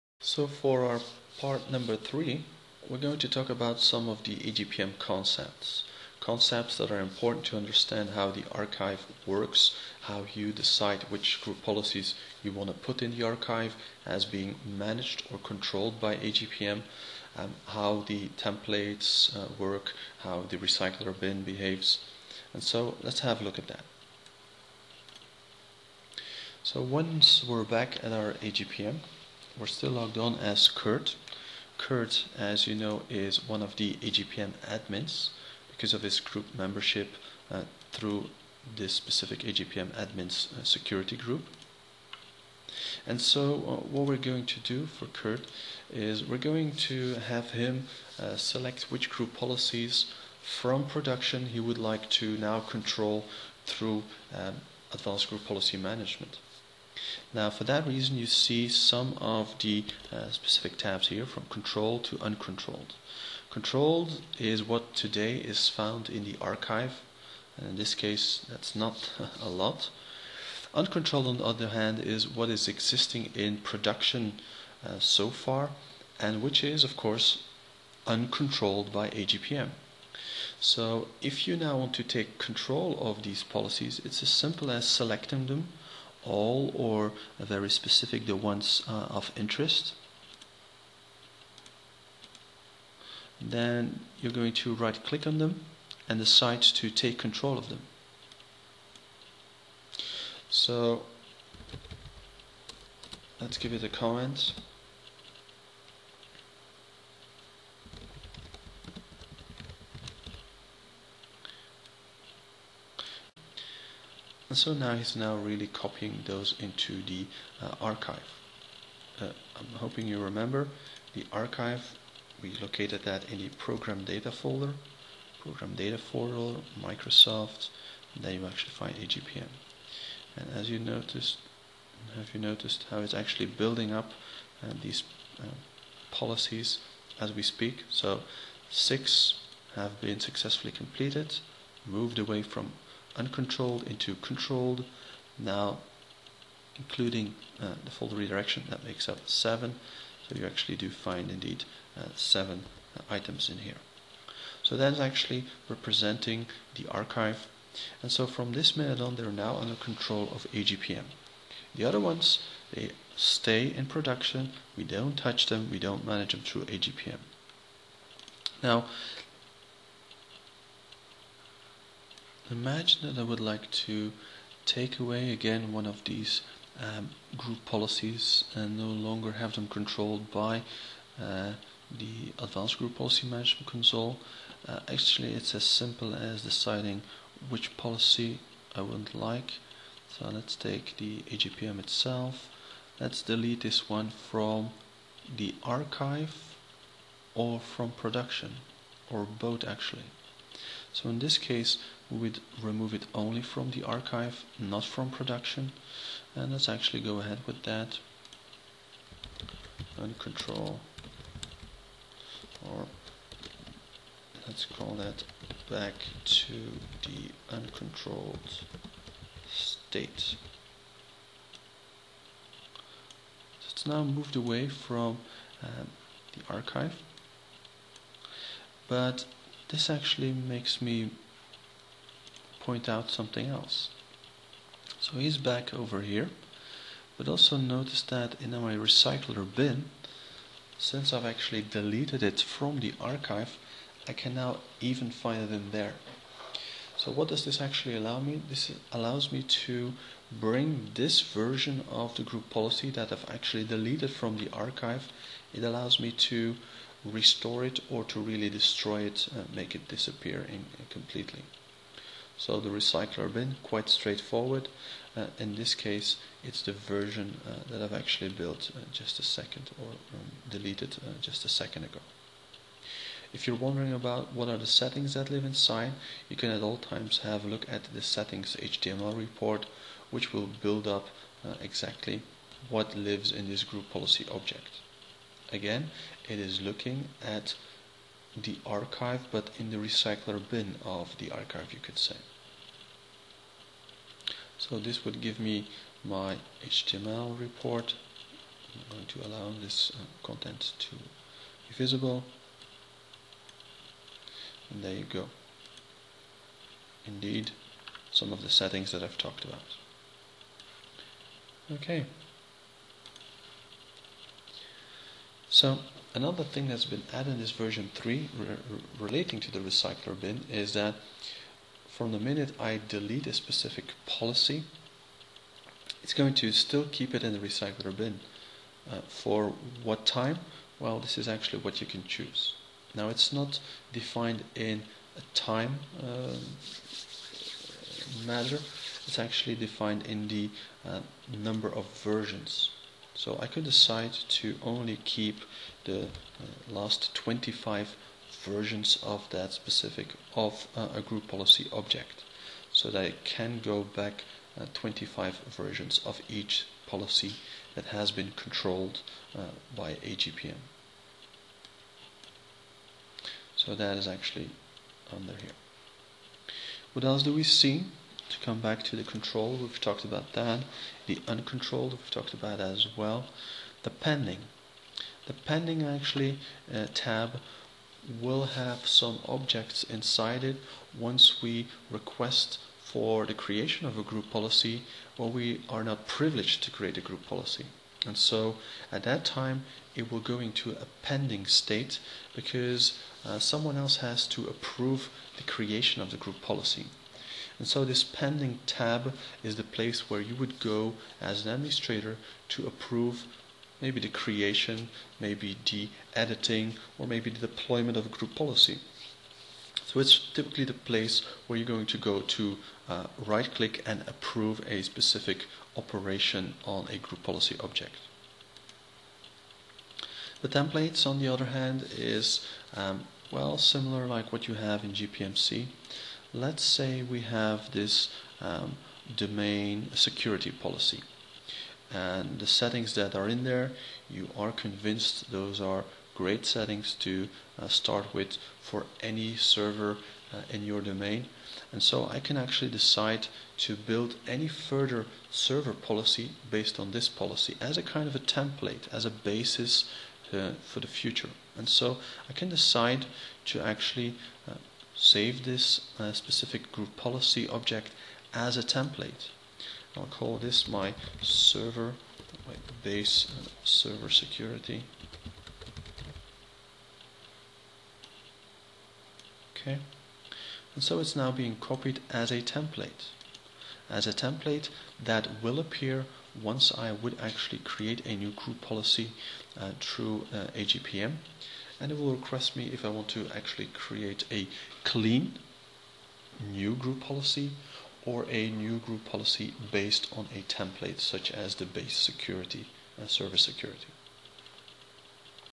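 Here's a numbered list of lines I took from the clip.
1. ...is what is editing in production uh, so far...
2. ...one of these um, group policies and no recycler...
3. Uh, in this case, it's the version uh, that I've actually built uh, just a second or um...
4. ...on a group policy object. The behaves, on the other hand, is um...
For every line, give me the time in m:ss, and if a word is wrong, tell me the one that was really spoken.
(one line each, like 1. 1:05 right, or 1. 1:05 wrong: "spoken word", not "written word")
1. 1:11 wrong: "existing", not "editing"
2. 2:55 wrong: "longer", not "recycler"
3. 4:25 right
4. 6:56 wrong: "templates", not "behaves".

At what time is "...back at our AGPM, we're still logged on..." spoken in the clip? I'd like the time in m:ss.
0:27.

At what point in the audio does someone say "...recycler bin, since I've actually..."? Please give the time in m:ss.
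3:58.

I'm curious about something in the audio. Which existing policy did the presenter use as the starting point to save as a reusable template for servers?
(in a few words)
domain security policy.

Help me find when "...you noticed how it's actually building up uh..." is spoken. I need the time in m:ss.
2:12.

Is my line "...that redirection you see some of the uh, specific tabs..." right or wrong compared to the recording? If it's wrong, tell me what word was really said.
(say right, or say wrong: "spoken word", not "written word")
wrong: "reason", not "redirection".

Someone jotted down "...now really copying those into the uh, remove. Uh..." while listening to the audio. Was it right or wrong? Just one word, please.
wrong.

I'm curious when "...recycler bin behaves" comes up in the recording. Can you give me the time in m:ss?
0:20.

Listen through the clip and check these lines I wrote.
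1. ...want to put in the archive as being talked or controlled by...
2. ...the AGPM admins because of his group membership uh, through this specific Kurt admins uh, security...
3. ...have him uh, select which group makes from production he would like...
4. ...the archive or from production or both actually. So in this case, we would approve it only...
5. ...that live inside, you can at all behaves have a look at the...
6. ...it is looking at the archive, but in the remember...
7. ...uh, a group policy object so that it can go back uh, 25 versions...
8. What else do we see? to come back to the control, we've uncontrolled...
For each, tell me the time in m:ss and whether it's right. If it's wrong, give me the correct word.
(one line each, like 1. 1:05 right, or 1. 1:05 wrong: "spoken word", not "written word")
1. 0:12 wrong: "managed", not "talked"
2. 0:33 wrong: "AGPM", not "Kurt"
3. 0:47 wrong: "policies", not "makes"
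4. 3:15 wrong: "remove", not "approve"
5. 4:35 wrong: "times", not "behaves"
6. 4:46 wrong: "recycler", not "remember"
7. 5:50 right
8. 6:06 wrong: "talked", not "uncontrolled".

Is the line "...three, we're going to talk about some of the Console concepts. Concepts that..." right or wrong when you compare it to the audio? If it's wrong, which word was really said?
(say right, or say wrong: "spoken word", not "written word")
wrong: "AGPM", not "Console".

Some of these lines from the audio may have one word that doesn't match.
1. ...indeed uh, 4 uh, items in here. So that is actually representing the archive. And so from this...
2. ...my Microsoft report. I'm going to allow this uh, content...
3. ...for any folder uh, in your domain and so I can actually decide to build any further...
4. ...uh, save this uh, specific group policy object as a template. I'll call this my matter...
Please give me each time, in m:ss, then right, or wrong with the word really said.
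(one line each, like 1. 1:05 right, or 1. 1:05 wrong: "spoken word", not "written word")
1. 2:31 wrong: "7", not "4"
2. 4:56 wrong: "HTML", not "Microsoft"
3. 7:18 wrong: "server", not "folder"
4. 7:34 wrong: "server", not "matter".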